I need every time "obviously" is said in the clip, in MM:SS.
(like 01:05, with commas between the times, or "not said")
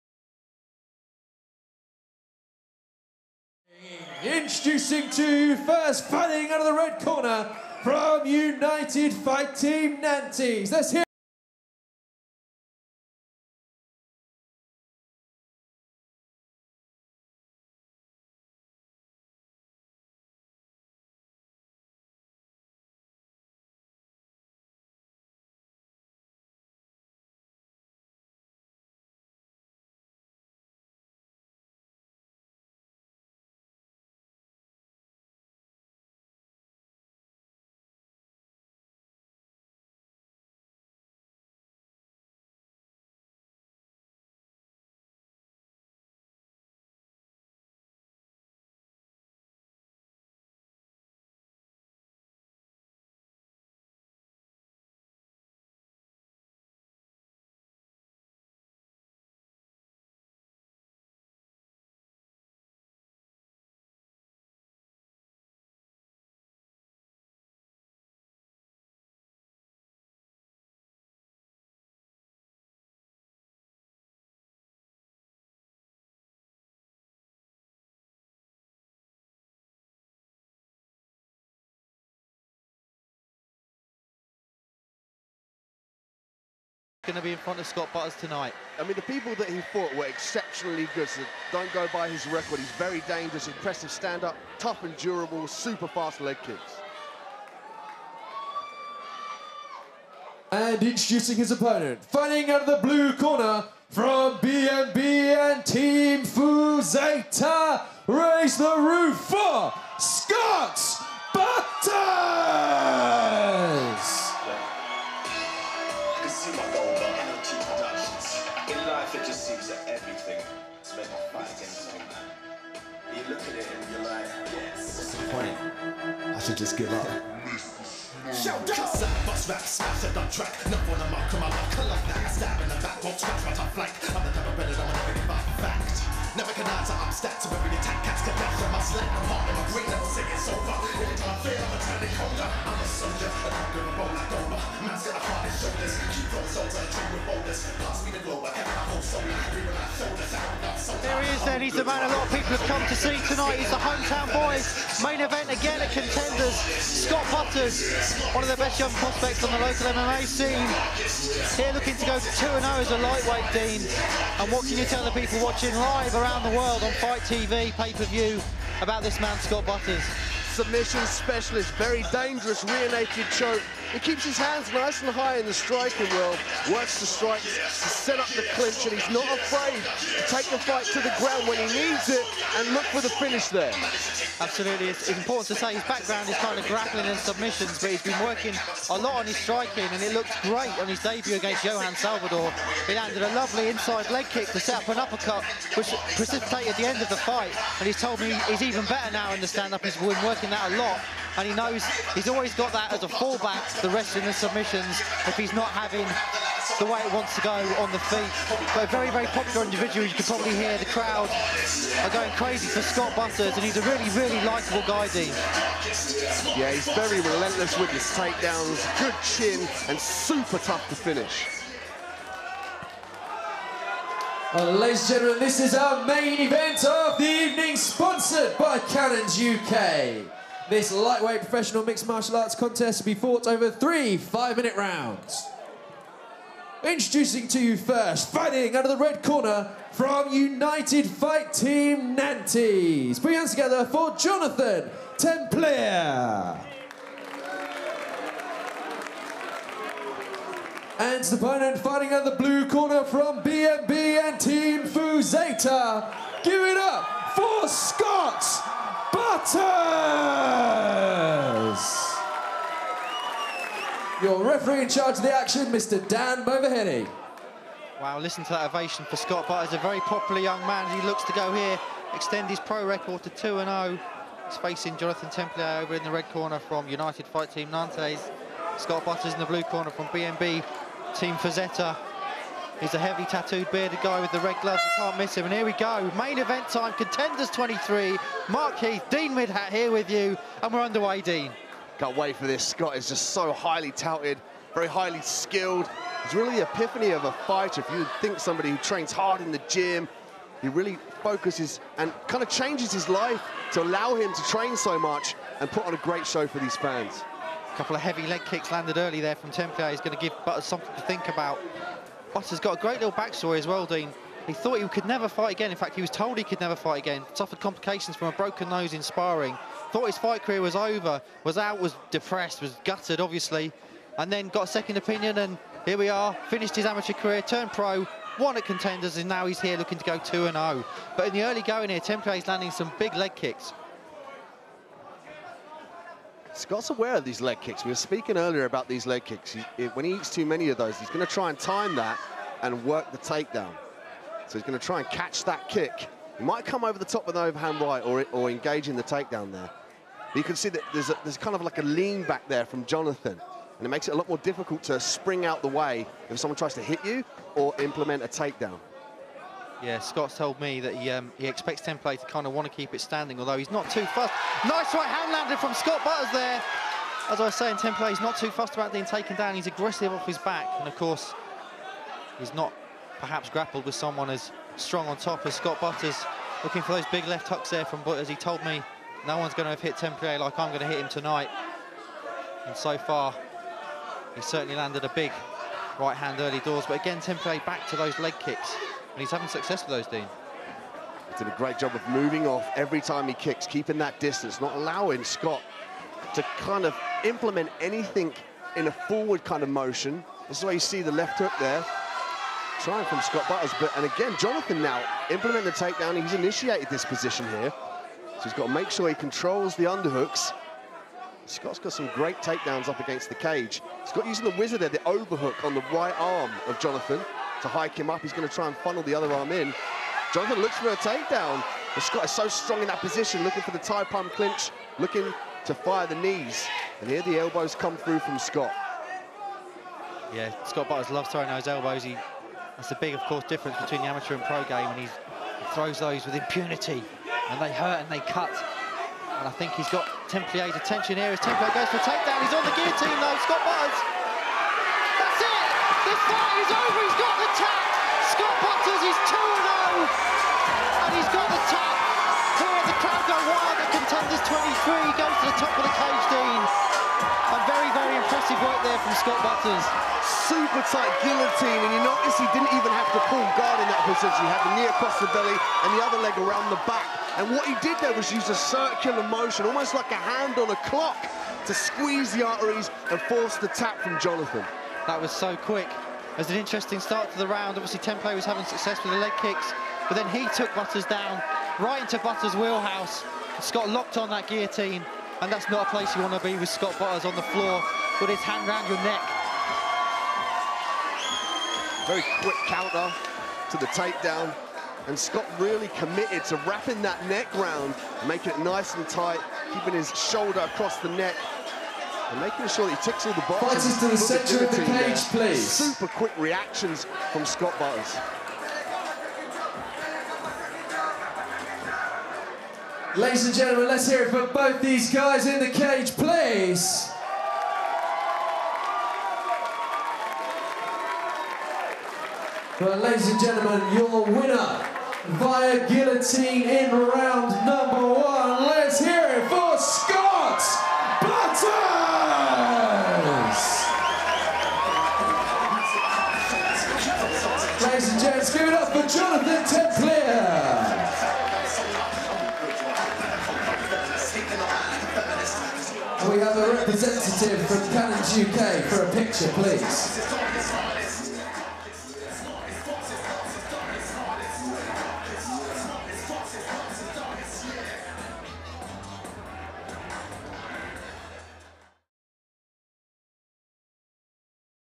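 05:23, 07:57.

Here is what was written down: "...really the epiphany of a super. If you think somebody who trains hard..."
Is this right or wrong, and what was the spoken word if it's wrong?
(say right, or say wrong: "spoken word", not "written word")
wrong: "fighter", not "super".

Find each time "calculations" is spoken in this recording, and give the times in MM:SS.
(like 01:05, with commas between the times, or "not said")
not said.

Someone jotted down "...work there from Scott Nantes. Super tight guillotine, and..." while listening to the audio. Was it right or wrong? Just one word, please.
wrong.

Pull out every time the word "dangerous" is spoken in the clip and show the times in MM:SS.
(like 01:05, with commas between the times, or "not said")
01:33, 02:52.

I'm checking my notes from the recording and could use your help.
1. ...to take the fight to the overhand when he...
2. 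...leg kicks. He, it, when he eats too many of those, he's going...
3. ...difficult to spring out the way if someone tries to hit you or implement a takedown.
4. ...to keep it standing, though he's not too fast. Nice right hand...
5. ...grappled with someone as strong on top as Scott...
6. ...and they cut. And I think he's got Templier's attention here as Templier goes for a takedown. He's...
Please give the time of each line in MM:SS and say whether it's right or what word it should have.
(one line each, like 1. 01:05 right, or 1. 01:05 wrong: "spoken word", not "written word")
1. 03:00 wrong: "ground", not "overhand"
2. 05:39 right
3. 05:54 right
4. 06:02 wrong: "although", not "though"
5. 06:13 right
6. 07:18 right.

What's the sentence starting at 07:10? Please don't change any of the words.
Yeah, Scott Butters loves throwing those elbows.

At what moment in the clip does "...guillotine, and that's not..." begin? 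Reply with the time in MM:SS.
08:04.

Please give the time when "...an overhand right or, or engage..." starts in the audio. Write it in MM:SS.
05:47.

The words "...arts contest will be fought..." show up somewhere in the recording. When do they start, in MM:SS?
03:52.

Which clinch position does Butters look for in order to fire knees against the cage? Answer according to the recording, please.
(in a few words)
Thai plum clinch.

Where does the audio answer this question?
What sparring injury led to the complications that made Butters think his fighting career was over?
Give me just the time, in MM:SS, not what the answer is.
05:18.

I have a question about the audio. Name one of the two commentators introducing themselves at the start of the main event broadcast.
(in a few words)
Mark Heath.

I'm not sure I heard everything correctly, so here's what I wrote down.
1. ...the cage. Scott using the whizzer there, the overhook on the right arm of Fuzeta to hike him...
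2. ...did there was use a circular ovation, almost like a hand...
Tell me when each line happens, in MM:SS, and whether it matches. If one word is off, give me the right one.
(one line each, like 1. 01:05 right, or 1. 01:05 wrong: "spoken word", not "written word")
1. 06:53 wrong: "Jonathan", not "Fuzeta"
2. 07:47 wrong: "motion", not "ovation".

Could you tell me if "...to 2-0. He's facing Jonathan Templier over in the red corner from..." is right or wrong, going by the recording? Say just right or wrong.
right.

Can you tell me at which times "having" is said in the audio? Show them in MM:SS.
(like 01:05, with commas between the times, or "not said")
03:25, 06:29, 07:58.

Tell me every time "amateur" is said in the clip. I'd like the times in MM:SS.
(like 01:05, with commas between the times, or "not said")
05:26, 07:14.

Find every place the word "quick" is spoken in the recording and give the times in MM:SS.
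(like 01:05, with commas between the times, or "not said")
07:55, 08:12, 08:26.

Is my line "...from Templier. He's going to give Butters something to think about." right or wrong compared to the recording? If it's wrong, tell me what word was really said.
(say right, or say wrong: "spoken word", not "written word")
right.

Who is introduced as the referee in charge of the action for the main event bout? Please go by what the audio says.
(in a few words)
Dan Moverhenny.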